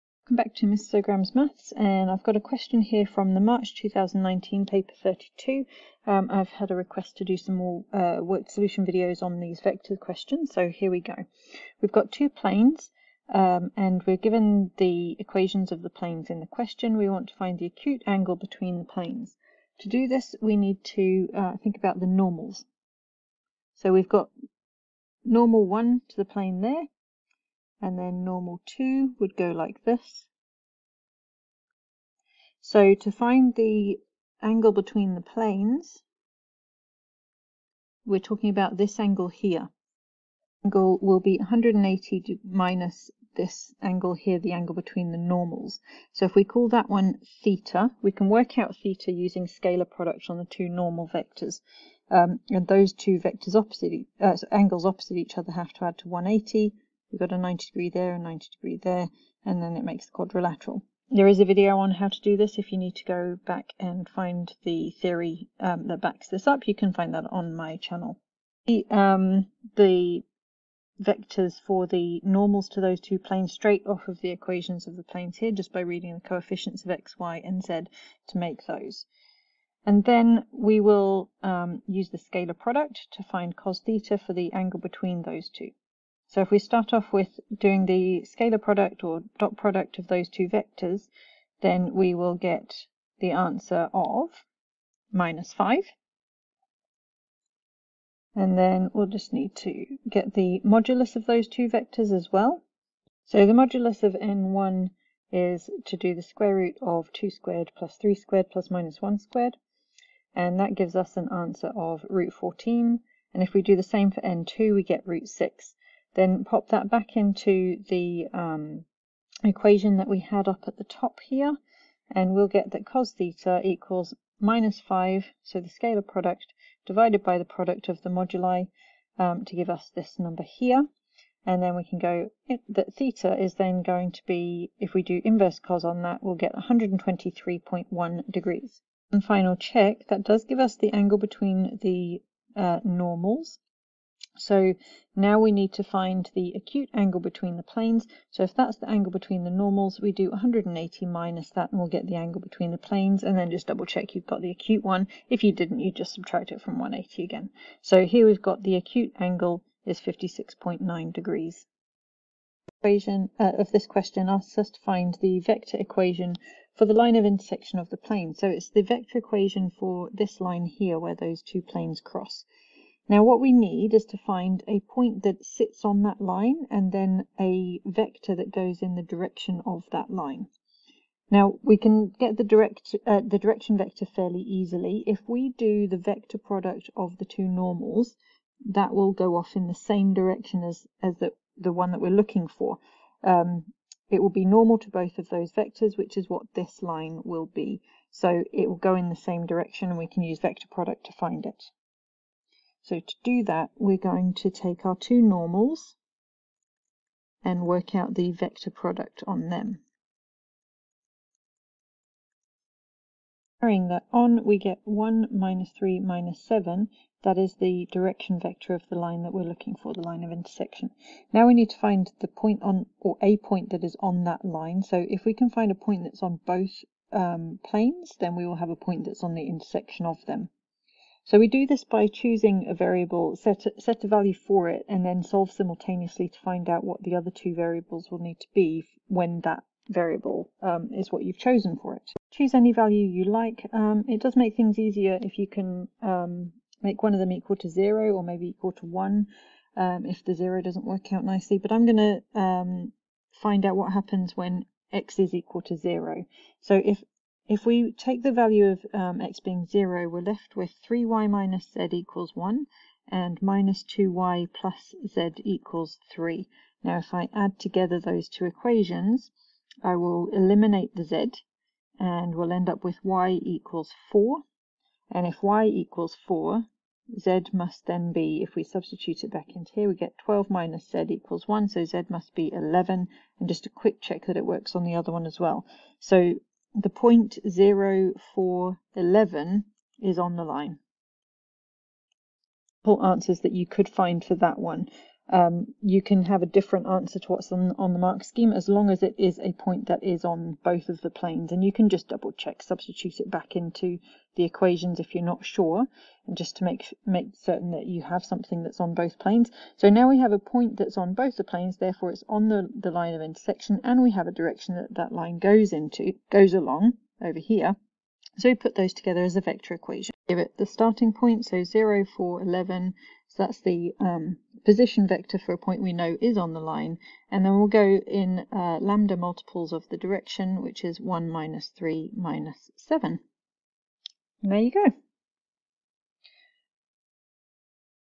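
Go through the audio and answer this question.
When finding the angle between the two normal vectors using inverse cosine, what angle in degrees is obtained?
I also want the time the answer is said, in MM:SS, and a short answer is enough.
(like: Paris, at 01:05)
123.1 degrees, at 02:16.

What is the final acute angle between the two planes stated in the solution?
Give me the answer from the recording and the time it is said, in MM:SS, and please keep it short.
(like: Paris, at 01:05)
56.9 degrees, at 02:39.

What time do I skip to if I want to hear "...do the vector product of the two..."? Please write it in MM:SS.
03:05.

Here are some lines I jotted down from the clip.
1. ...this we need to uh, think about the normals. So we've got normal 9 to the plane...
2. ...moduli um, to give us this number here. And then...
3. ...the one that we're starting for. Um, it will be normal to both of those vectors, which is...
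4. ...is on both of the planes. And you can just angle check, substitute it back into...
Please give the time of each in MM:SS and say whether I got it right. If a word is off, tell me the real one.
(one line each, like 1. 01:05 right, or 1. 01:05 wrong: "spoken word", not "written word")
1. 00:20 wrong: "1", not "9"
2. 02:08 right
3. 03:11 wrong: "looking", not "starting"
4. 05:00 wrong: "double", not "angle".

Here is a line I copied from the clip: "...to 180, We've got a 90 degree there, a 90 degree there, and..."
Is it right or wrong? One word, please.
right.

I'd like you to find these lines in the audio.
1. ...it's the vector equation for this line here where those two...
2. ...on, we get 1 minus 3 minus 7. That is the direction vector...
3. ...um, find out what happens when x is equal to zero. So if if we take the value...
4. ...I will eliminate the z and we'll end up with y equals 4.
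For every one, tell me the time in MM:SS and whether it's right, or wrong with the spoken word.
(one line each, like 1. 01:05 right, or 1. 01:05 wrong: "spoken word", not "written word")
1. 02:48 right
2. 03:34 right
3. 04:12 right
4. 04:29 right.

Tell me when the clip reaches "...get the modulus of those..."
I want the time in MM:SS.
01:40.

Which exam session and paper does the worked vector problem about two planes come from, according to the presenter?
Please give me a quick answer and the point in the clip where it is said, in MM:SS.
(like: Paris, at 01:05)
March 2019 paper 32, at 00:03.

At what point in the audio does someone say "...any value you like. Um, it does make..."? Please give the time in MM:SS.
04:02.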